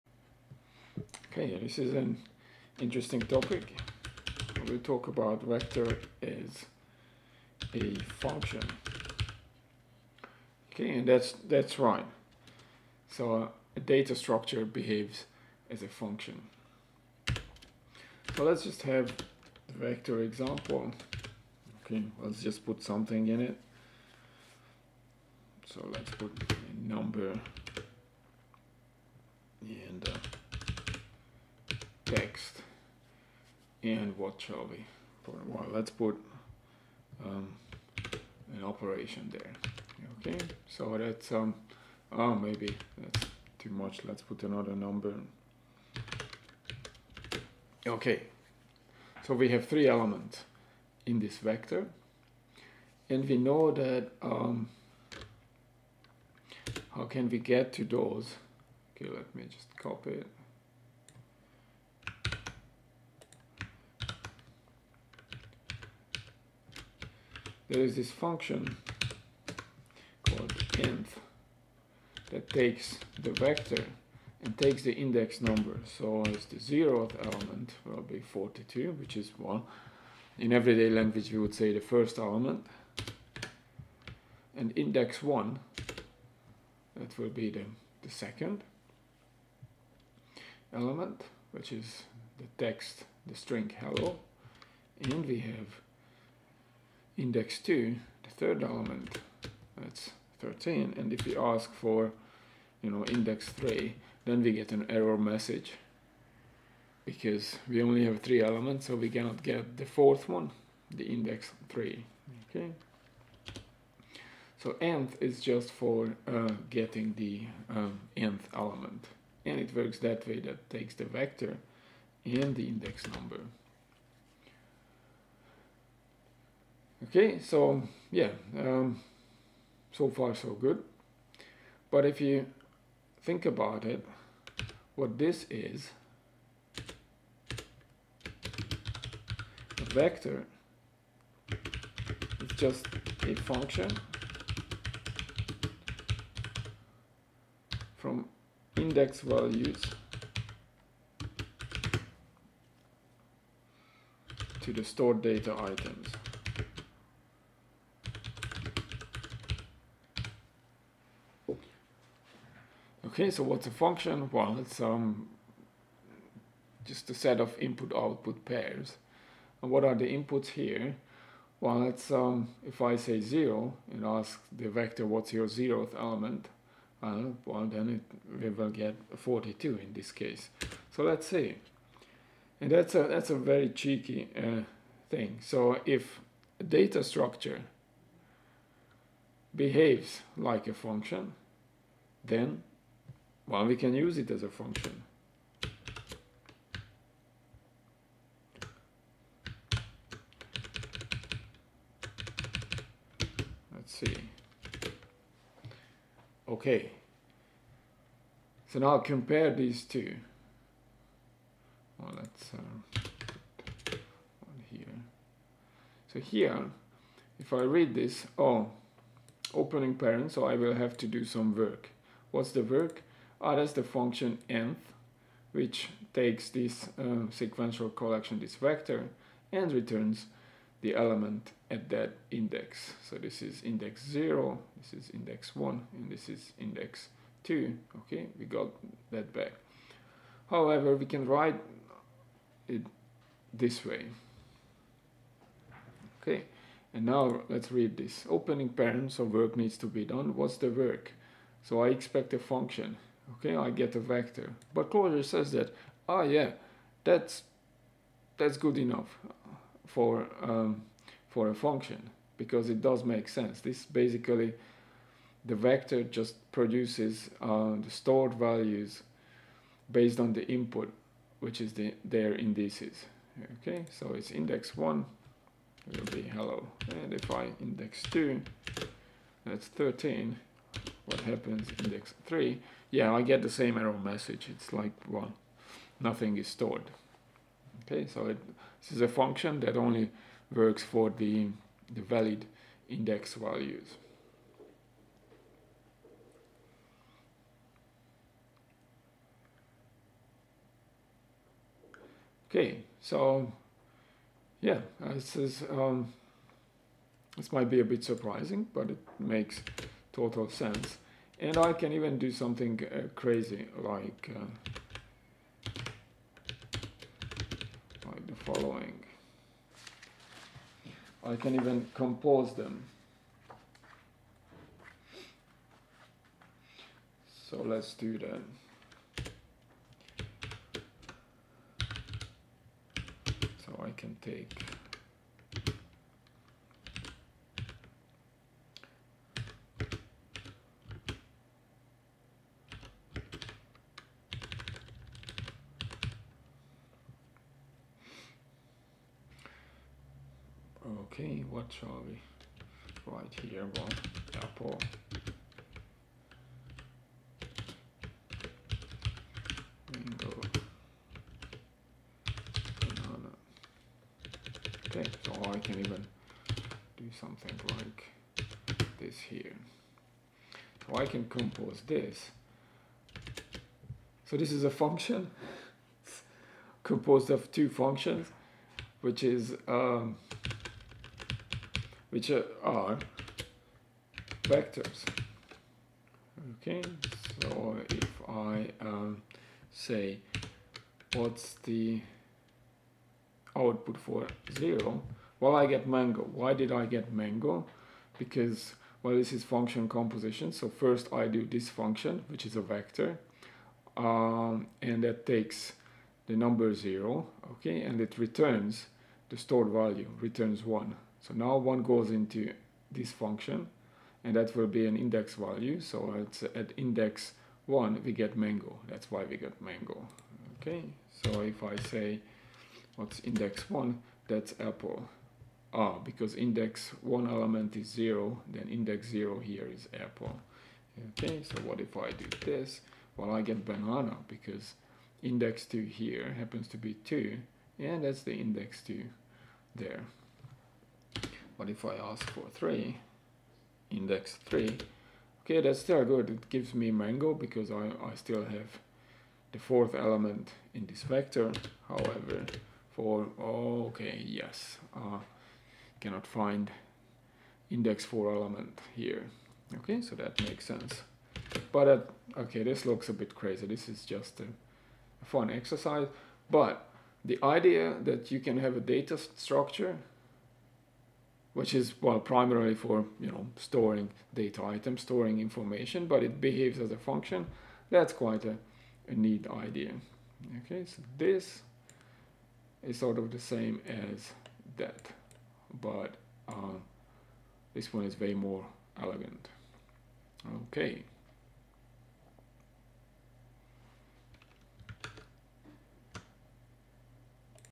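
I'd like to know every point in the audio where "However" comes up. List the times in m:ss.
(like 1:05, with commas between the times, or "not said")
4:00, 7:31.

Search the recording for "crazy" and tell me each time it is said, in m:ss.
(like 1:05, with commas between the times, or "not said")
5:13, 7:43.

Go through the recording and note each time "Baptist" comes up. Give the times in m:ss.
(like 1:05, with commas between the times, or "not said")
not said.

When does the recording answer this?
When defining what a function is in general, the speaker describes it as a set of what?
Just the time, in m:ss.
2:47.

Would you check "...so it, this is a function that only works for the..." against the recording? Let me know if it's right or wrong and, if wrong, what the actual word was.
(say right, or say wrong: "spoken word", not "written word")
right.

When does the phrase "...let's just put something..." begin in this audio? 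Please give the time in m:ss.
0:22.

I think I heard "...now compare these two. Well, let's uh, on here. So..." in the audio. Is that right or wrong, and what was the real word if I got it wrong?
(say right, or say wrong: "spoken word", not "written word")
right.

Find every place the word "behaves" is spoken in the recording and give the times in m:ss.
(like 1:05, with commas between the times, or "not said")
0:14, 3:09, 7:56.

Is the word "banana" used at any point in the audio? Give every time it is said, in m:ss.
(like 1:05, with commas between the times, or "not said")
6:02, 7:13.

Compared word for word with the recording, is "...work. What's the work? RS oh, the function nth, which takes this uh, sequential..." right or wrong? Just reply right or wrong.
right.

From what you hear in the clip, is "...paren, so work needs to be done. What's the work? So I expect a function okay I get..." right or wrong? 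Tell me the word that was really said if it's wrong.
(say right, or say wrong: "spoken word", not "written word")
right.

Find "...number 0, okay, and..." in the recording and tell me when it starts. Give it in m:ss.
6:46.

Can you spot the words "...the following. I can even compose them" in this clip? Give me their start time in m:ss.
5:18.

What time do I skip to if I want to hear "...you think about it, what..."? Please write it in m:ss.
2:12.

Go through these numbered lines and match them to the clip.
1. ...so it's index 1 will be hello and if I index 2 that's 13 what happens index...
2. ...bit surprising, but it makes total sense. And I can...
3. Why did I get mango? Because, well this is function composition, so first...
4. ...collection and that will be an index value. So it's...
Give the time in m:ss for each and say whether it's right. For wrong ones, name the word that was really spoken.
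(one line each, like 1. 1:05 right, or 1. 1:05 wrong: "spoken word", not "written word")
1. 4:33 right
2. 5:07 right
3. 6:36 right
4. 6:53 wrong: "function", not "collection".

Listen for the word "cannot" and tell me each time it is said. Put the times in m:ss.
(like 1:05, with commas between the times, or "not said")
1:49, 7:35.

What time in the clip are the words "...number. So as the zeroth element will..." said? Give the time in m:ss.
1:15.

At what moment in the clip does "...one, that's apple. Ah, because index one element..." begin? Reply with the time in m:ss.
7:03.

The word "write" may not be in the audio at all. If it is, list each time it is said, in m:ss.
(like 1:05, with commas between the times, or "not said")
4:01, 5:53.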